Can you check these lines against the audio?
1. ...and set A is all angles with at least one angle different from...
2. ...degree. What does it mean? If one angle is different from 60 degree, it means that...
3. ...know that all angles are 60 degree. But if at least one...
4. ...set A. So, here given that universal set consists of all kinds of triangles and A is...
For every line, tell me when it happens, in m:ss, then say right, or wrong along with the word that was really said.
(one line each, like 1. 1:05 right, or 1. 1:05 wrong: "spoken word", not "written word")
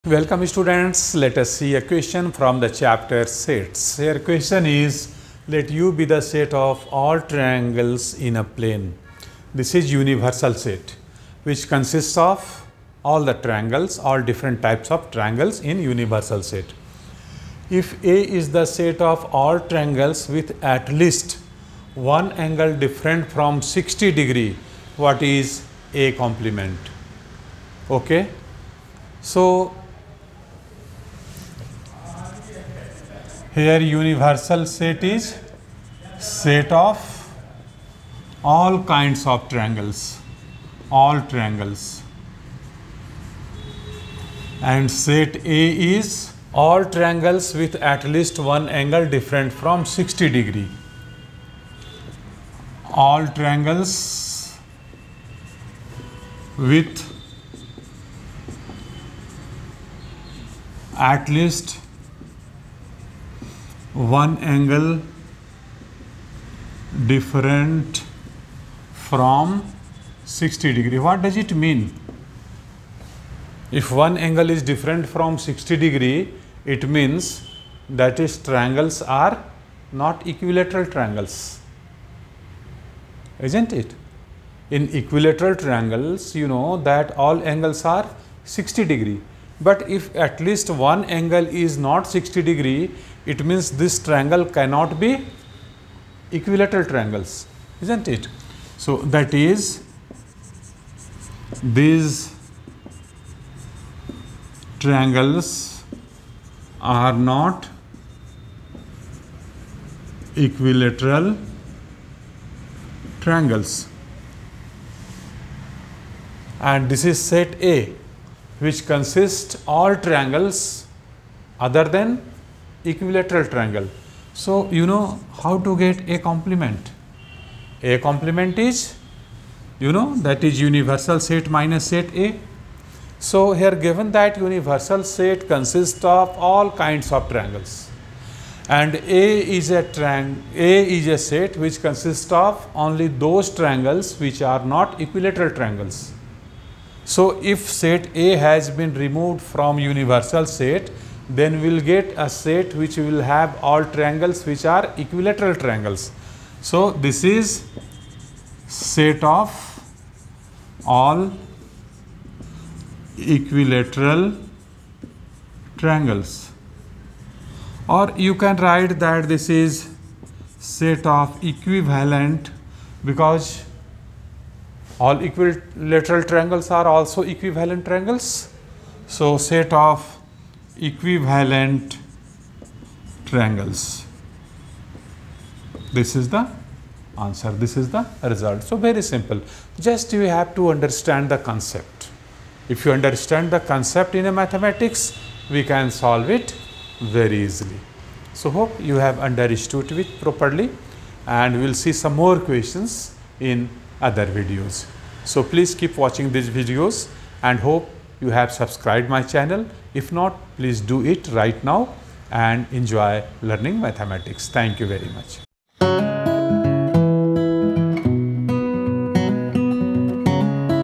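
1. 0:44 wrong: "triangles", not "angles"
2. 1:10 right
3. 1:26 right
4. 2:11 right.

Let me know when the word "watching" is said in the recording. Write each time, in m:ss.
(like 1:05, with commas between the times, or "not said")
3:25.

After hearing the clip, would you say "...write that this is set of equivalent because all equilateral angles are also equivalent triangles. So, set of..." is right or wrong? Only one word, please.
wrong.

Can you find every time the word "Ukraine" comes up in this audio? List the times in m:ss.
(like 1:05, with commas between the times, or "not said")
not said.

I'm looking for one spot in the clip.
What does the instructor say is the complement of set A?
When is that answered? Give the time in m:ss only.
2:38.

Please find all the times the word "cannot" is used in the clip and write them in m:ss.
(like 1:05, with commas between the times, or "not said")
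1:34.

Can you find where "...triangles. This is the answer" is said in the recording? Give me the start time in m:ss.
3:03.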